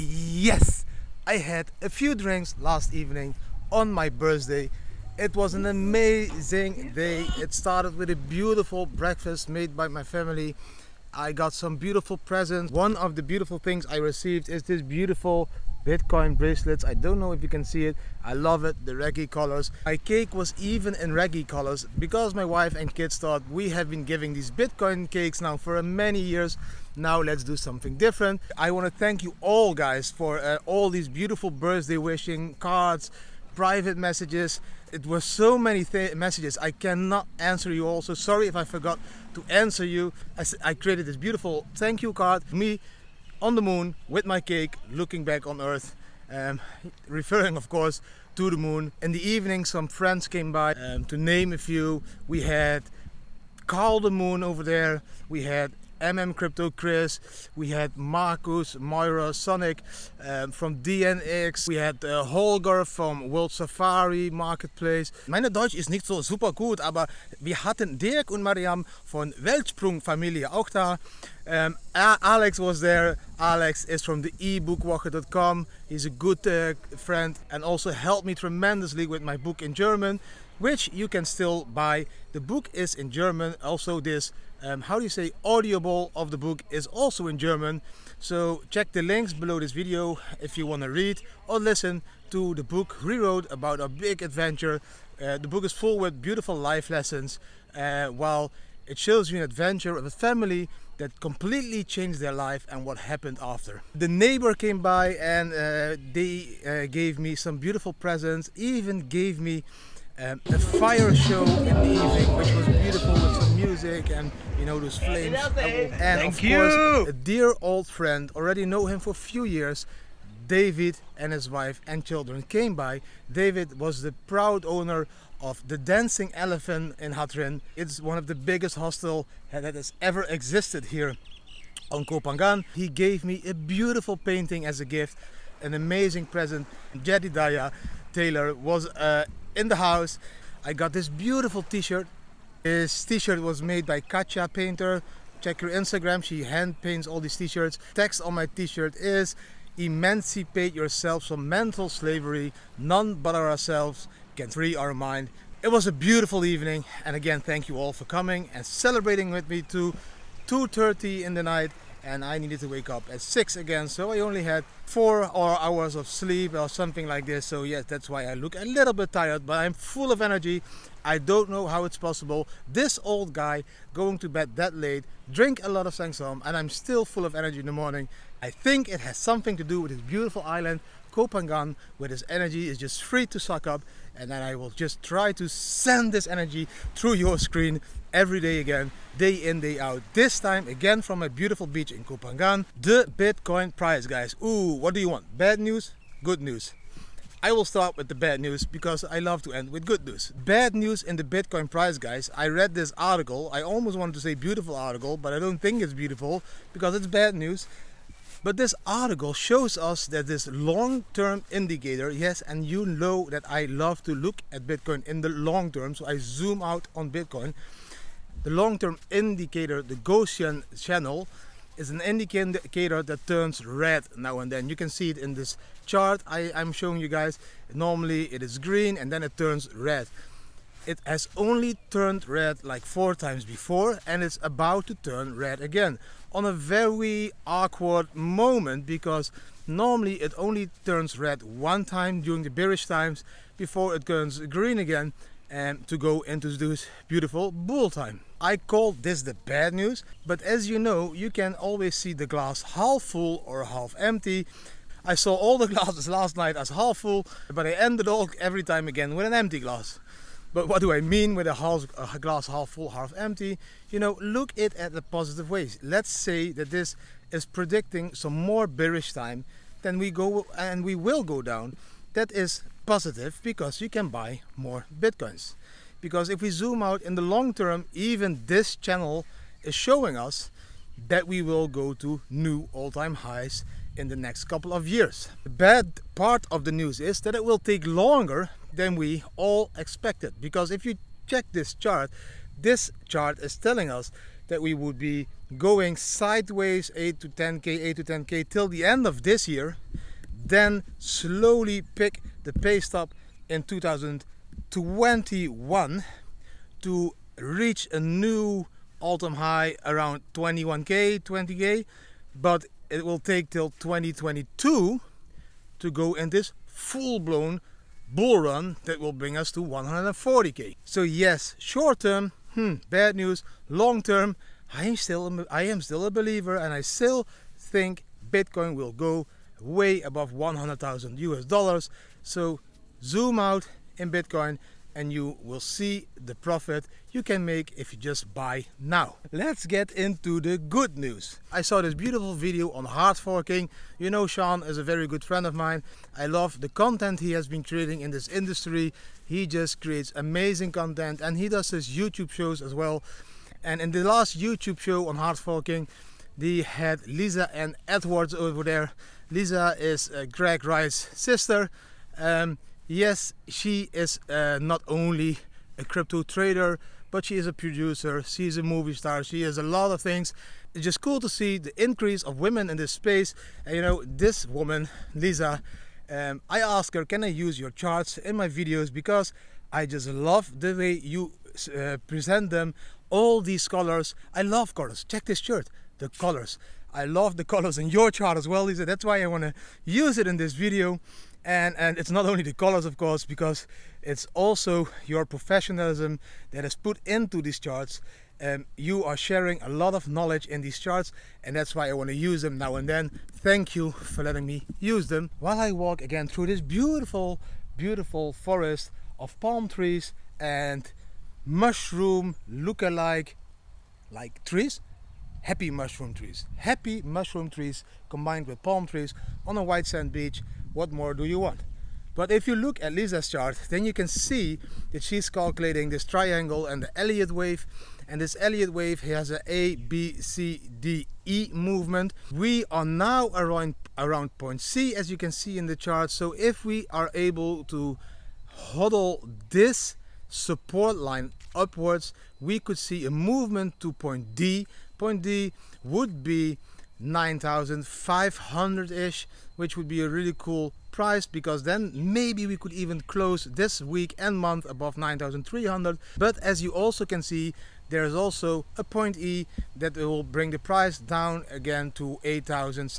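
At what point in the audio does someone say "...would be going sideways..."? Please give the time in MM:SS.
04:54.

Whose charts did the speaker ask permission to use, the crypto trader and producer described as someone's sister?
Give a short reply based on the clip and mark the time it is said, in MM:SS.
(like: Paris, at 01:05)
Lisa N Edwards, at 05:57.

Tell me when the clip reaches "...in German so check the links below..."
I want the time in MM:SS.
01:27.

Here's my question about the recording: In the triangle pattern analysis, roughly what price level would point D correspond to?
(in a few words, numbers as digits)
9,500.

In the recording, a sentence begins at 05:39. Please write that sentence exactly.
Let's get into the good news.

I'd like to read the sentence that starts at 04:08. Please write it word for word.
I call this the bad news, but as you know, you can always see the glass half full or half empty.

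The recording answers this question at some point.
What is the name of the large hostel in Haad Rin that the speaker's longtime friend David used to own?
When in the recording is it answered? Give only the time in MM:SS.
02:05.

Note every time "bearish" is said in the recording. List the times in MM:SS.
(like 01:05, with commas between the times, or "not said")
04:02, 04:28.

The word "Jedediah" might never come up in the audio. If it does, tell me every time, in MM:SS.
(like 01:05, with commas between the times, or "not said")
02:17.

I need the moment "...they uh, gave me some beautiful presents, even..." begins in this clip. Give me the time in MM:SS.
01:46.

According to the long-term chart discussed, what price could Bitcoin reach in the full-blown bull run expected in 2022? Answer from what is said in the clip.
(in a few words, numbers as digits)
140k.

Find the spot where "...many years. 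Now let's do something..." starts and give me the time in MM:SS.
00:25.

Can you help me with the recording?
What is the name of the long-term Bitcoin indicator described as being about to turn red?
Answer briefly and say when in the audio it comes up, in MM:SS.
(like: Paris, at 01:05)
Gaussian channel, at 03:39.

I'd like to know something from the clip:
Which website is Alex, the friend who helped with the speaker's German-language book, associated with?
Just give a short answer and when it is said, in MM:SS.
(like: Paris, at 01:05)
ebookwoche.com, at 01:14.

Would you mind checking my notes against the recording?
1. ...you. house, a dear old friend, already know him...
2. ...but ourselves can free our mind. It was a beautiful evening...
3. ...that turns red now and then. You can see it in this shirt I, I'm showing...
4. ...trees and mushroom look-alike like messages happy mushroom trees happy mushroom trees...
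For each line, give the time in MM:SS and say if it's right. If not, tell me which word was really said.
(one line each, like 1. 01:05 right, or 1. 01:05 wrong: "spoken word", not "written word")
1. 01:56 wrong: "course", not "house"
2. 02:33 right
3. 03:43 wrong: "chart", not "shirt"
4. 06:49 wrong: "trees", not "messages".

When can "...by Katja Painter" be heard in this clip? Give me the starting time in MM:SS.
02:23.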